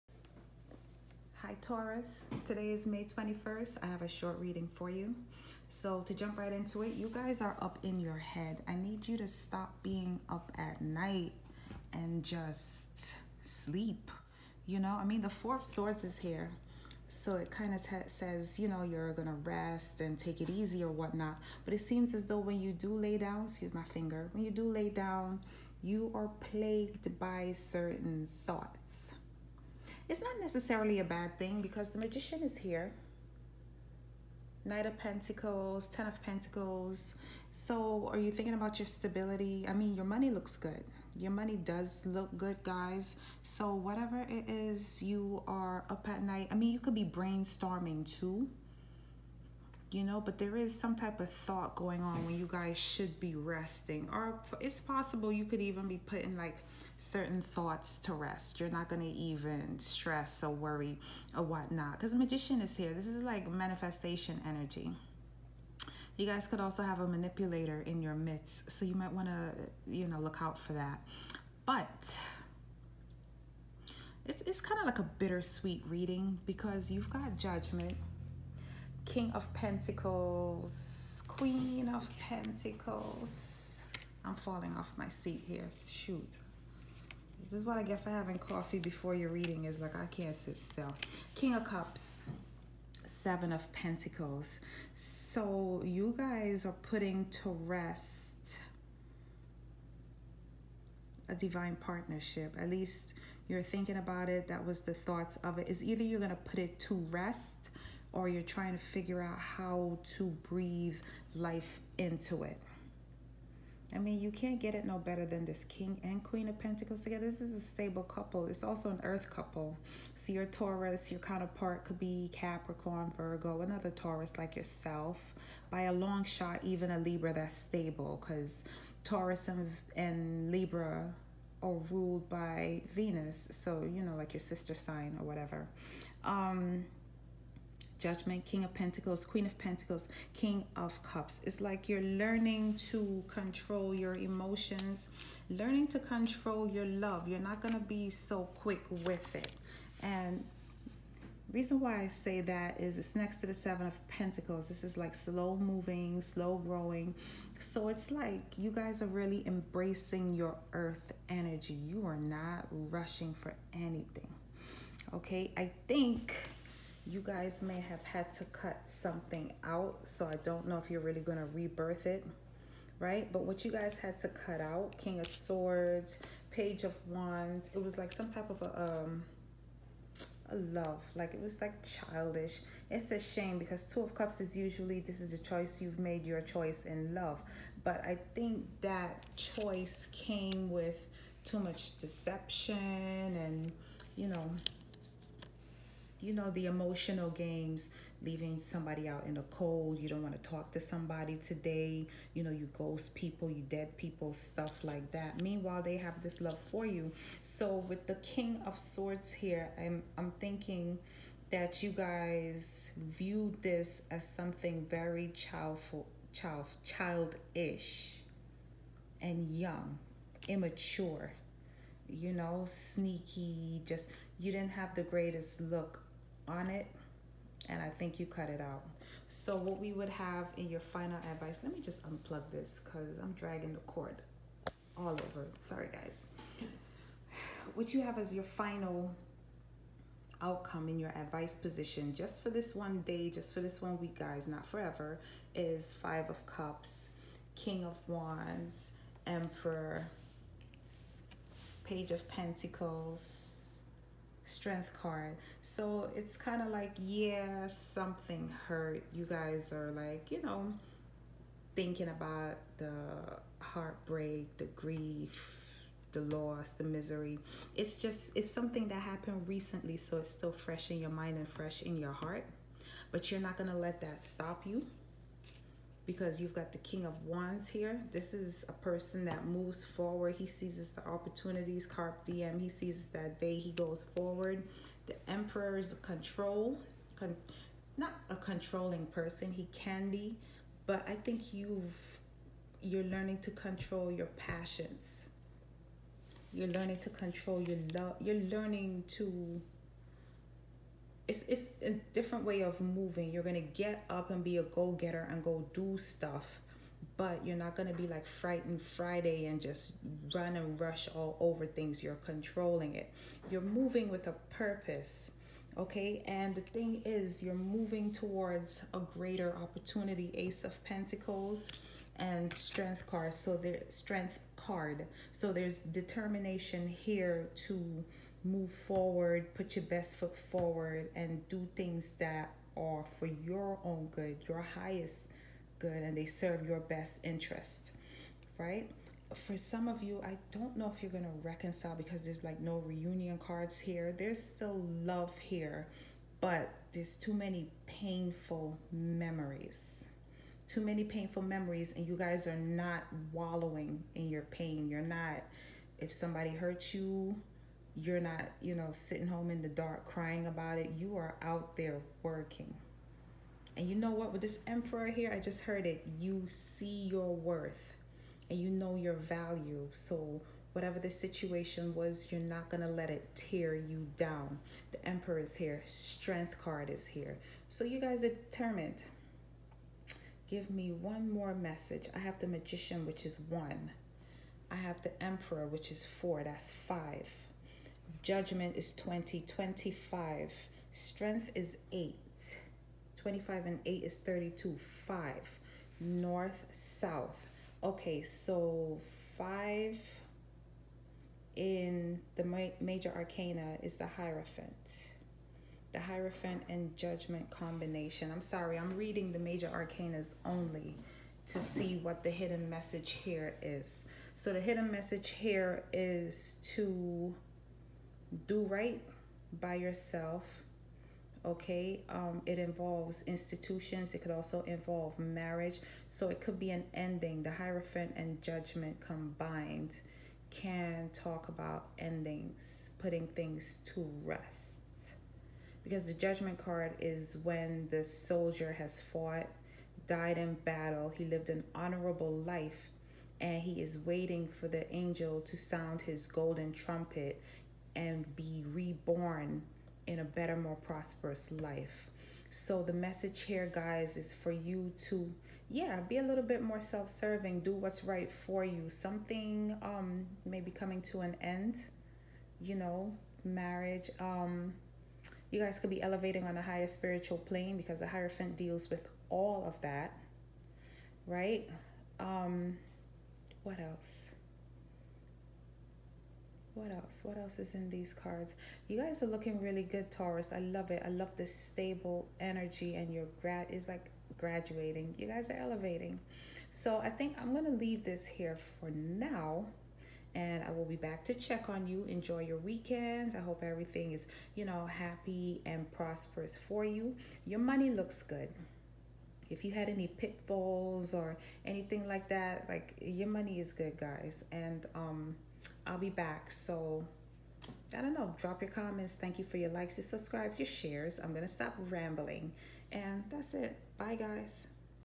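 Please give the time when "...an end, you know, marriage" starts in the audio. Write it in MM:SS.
07:41.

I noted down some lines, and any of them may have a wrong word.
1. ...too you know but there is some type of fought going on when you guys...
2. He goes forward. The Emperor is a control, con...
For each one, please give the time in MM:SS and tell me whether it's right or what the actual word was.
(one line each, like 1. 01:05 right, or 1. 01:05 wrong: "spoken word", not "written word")
1. 00:48 wrong: "thought", not "fought"
2. 04:43 right.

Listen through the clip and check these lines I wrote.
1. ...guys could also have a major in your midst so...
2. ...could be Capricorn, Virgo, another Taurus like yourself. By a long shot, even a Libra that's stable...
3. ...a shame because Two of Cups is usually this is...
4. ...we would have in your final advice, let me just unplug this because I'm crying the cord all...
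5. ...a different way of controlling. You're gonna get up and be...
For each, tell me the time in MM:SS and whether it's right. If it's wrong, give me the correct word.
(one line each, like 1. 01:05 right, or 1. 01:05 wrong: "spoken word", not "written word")
1. 01:06 wrong: "manipulator", not "major"
2. 02:01 right
3. 03:03 right
4. 03:49 wrong: "dragging", not "crying"
5. 05:01 wrong: "moving", not "controlling".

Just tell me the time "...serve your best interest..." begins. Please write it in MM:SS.
05:36.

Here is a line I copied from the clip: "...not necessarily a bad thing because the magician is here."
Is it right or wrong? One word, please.
right.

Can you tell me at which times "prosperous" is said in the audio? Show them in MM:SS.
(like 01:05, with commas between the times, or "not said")
07:30, 08:15.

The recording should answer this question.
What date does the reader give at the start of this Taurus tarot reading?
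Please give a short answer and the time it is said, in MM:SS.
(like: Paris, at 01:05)
May 21st, at 00:02.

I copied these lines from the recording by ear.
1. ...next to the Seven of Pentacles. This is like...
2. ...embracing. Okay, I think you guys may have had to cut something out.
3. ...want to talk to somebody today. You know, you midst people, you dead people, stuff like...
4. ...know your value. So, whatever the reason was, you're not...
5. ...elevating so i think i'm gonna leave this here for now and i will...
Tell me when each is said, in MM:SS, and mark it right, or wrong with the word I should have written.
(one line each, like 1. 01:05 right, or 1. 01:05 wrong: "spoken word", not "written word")
1. 02:33 right
2. 02:43 wrong: "anything", not "embracing"
3. 03:20 wrong: "ghost", not "midst"
4. 06:08 wrong: "situation", not "reason"
5. 08:05 right.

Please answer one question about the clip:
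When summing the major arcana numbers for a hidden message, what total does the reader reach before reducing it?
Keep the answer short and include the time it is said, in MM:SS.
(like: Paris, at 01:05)
32, at 06:34.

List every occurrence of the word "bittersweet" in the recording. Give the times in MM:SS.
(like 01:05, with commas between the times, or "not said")
01:15.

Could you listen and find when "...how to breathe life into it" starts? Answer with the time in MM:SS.
01:49.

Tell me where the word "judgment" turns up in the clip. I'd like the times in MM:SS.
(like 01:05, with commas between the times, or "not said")
01:17, 02:18, 06:28, 06:46, 07:08, 07:16.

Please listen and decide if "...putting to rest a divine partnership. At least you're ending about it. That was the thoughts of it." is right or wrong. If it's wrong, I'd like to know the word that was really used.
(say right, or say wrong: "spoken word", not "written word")
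wrong: "thinking", not "ending".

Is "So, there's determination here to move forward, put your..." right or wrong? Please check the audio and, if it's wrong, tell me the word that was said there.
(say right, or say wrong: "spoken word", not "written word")
right.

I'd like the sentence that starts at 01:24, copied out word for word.
I'm falling off my seat here.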